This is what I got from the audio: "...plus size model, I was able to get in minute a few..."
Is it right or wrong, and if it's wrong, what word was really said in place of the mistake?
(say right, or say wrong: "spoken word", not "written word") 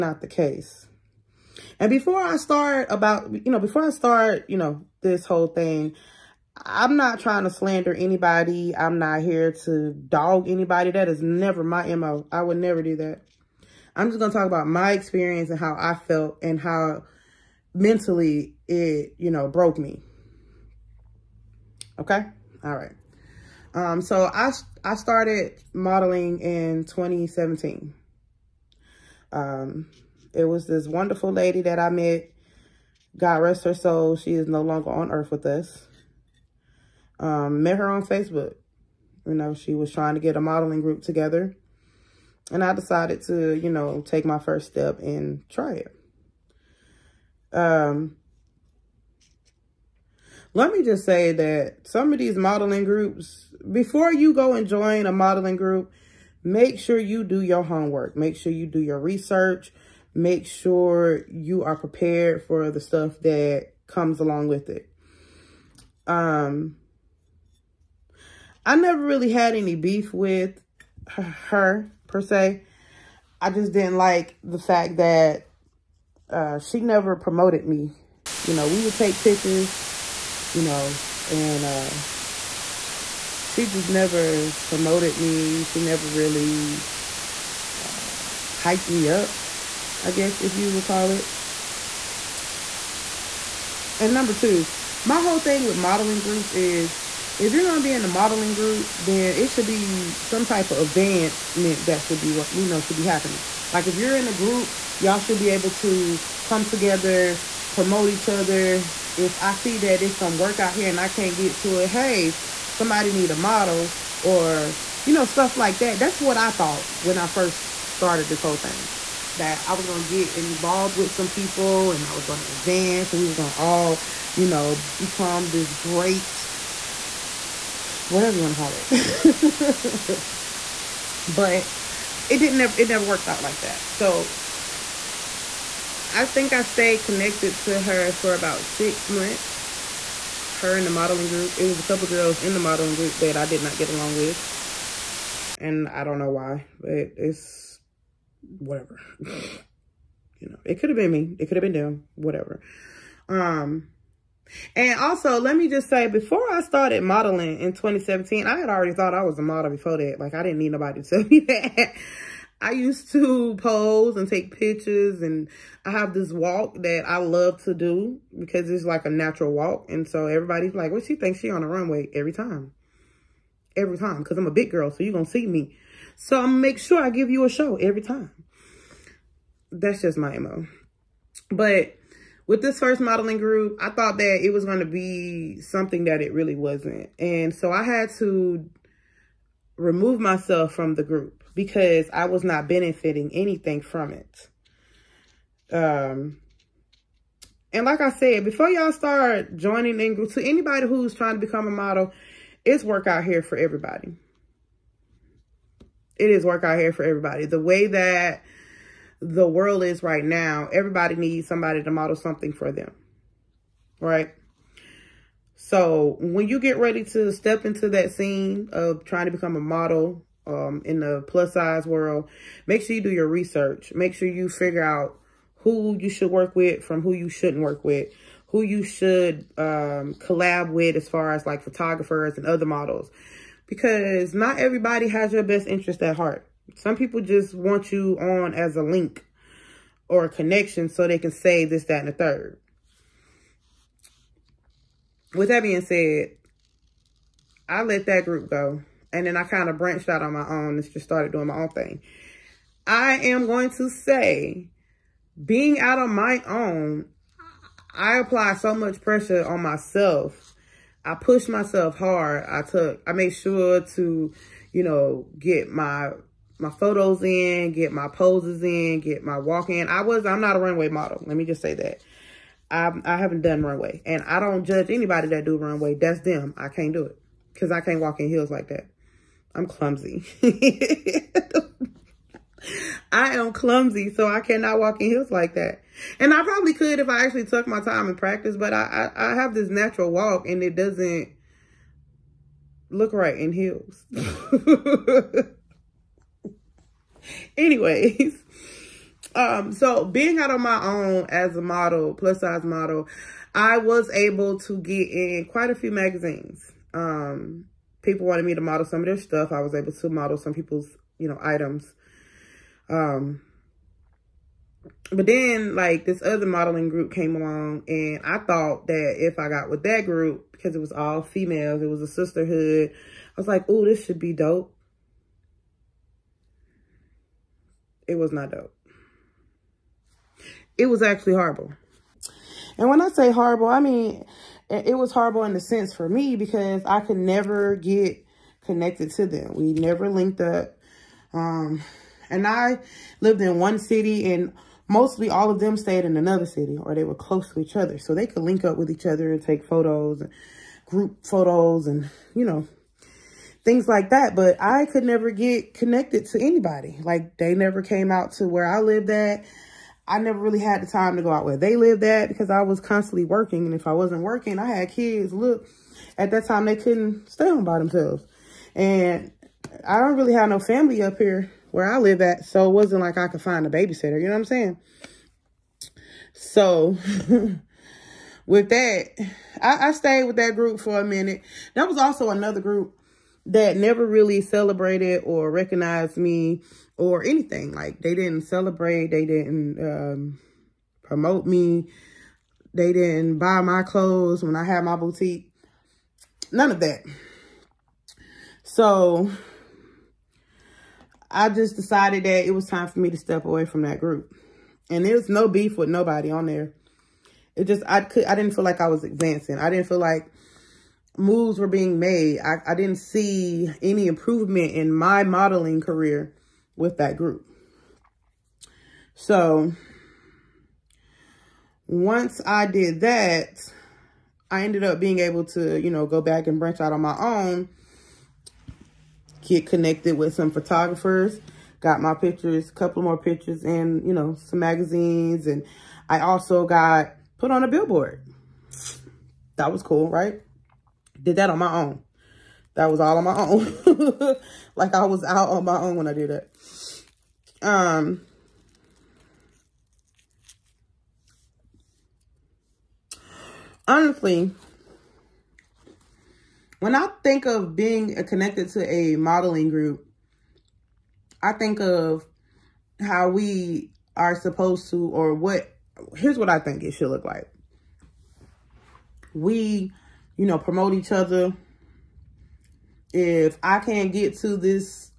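wrong: "quite", not "minute".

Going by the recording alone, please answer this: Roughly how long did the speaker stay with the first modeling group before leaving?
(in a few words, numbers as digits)
6 months.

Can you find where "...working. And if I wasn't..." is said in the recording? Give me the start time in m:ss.
6:03.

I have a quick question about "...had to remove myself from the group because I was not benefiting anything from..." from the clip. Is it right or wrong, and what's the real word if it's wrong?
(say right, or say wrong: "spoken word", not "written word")
right.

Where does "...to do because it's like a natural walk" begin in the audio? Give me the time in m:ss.
2:47.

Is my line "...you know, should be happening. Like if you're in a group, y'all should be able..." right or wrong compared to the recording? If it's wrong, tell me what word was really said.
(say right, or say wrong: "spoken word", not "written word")
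right.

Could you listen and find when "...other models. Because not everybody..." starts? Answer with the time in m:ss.
3:52.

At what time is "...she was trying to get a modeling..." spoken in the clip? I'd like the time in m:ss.
0:39.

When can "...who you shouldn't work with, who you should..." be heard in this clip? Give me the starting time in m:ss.
3:47.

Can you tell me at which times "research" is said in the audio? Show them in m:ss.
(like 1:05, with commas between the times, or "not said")
0:58, 3:43.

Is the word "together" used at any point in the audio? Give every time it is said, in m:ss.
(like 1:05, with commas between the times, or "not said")
0:41, 1:46.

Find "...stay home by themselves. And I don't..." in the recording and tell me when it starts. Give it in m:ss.
6:07.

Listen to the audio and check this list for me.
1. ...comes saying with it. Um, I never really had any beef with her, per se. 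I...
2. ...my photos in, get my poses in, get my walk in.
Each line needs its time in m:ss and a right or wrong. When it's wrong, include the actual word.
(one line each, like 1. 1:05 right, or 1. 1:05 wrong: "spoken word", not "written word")
1. 1:03 wrong: "along", not "saying"
2. 4:26 right.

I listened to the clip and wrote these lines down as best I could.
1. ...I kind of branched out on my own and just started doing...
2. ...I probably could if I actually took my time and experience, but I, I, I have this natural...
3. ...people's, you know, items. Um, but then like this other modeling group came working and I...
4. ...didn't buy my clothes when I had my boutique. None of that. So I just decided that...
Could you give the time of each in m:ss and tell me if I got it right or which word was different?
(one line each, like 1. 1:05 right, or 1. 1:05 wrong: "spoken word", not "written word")
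1. 4:09 right
2. 4:46 wrong: "practice", not "experience"
3. 5:10 wrong: "along", not "working"
4. 6:32 right.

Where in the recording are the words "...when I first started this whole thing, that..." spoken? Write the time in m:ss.
1:56.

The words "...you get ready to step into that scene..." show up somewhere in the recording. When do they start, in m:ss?
3:36.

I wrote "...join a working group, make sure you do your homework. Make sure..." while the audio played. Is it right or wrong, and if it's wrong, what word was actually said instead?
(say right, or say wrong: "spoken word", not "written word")
wrong: "modeling", not "working".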